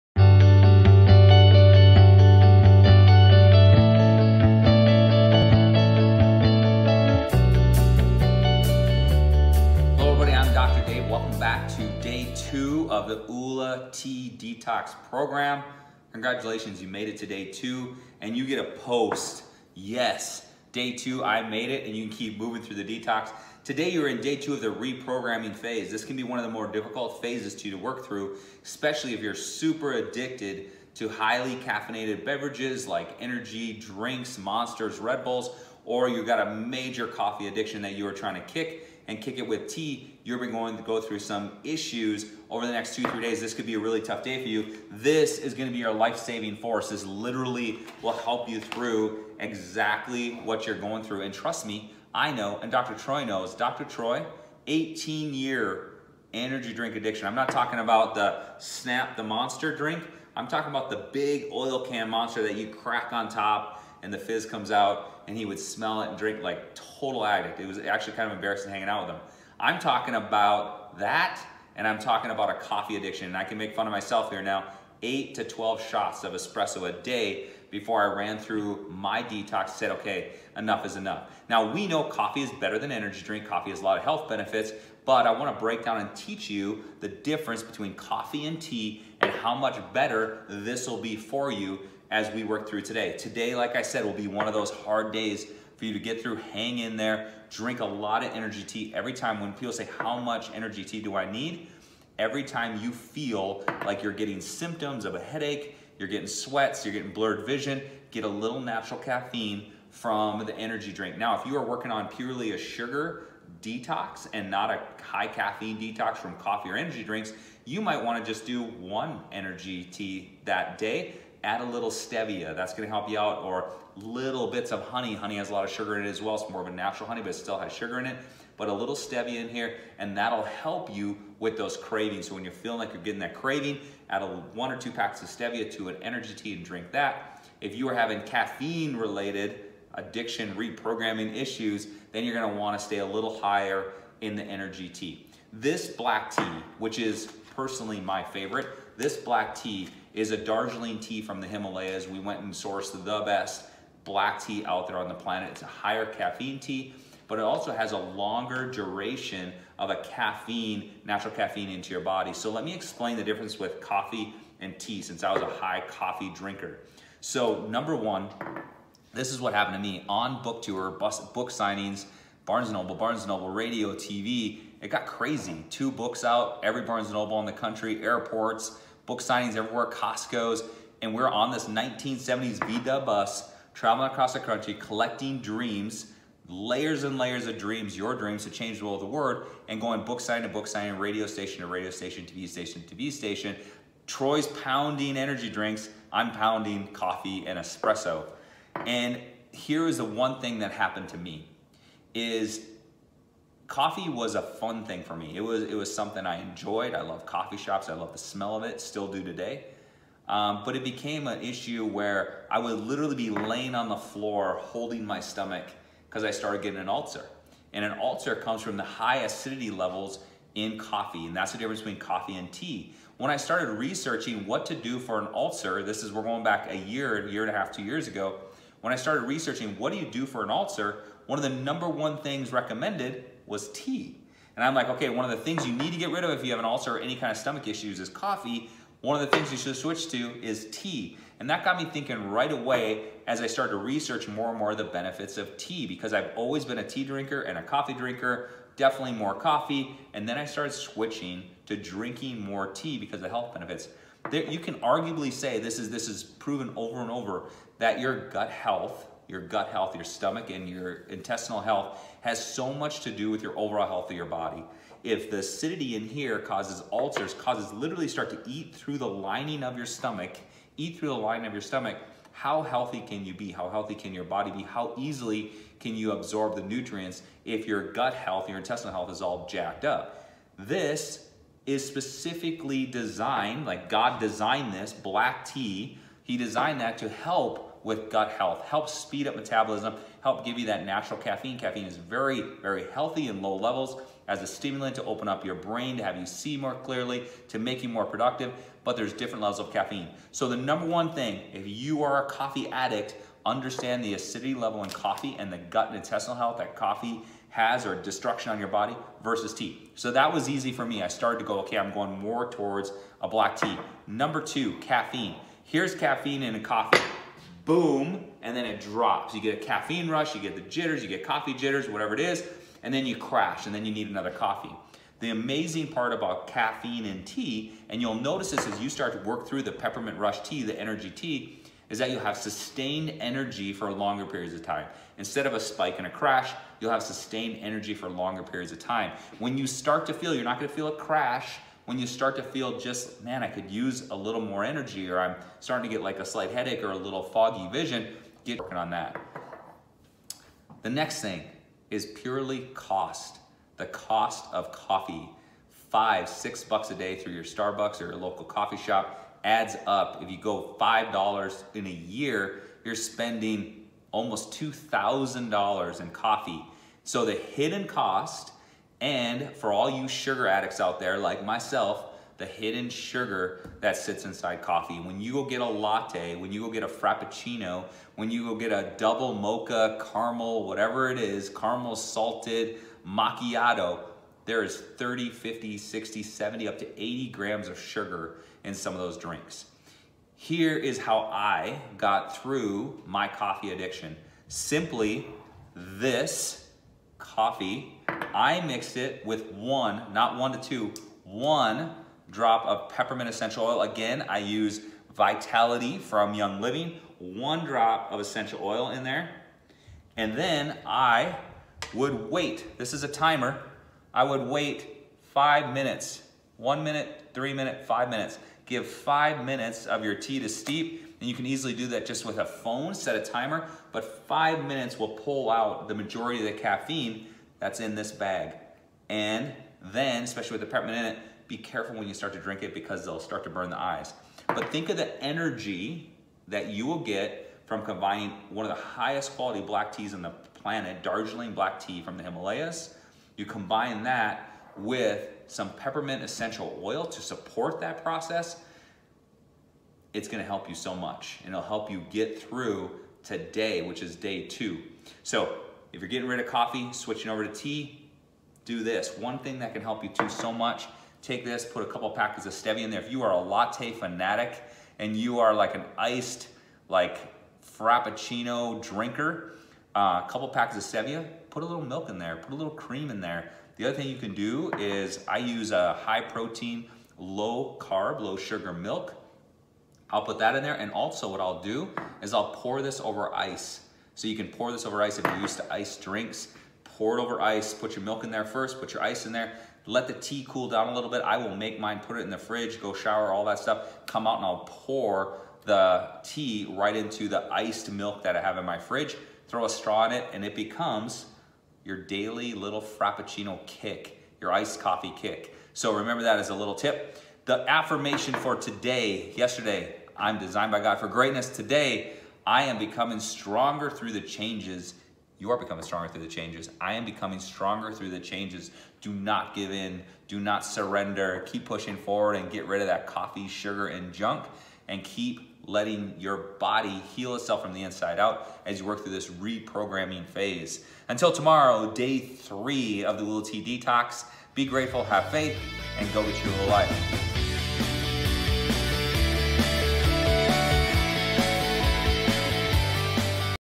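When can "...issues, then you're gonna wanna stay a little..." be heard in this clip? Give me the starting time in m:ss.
2:21.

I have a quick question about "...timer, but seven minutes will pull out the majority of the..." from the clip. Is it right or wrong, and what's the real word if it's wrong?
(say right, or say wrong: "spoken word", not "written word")
wrong: "five", not "seven".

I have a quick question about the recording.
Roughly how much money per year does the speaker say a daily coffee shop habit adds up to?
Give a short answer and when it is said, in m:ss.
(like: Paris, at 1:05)
almost $2,000, at 6:04.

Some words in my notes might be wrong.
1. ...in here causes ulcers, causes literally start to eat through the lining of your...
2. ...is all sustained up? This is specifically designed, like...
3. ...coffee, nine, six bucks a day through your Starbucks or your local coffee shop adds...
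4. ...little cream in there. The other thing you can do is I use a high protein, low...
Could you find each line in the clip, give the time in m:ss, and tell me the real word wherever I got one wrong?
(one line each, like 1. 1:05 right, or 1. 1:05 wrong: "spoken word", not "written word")
1. 4:25 right
2. 4:39 wrong: "jacked", not "sustained"
3. 5:54 wrong: "five", not "nine"
4. 7:52 right.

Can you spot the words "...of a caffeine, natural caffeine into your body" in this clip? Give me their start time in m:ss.
2:39.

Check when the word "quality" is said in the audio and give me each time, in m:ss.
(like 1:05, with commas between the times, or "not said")
7:19.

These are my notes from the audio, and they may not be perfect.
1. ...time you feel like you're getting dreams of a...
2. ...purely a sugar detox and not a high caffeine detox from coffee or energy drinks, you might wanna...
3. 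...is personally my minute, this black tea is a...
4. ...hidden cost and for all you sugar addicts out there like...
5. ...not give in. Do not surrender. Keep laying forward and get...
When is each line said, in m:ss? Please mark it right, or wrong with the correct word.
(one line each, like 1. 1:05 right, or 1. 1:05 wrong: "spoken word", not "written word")
1. 1:42 wrong: "symptoms", not "dreams"
2. 1:52 right
3. 2:26 wrong: "favorite", not "minute"
4. 6:07 right
5. 8:39 wrong: "pushing", not "laying".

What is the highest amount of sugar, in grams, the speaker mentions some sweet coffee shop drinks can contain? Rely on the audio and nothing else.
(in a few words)
80 grams.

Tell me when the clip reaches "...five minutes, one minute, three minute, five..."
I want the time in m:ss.
6:55.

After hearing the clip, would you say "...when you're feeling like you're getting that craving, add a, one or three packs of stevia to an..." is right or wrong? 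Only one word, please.
wrong.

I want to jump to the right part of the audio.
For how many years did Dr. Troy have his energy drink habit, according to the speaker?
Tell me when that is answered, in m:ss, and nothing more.
0:54.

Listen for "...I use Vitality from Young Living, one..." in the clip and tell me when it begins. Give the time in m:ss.
6:44.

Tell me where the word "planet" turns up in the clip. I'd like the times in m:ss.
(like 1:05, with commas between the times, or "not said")
2:35, 7:20.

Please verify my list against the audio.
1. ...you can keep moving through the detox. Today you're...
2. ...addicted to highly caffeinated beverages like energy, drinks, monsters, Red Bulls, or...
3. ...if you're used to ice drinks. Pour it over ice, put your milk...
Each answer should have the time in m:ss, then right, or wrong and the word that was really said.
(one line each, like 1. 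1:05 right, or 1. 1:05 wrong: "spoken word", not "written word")
1. 0:21 right
2. 0:29 right
3. 8:05 right.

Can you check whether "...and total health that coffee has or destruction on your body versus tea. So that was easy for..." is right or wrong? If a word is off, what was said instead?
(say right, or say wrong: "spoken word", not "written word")
wrong: "intestinal", not "total".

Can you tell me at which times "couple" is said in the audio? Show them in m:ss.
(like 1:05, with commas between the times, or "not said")
7:41, 7:50.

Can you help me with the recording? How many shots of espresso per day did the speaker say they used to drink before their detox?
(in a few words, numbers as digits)
8 to 12.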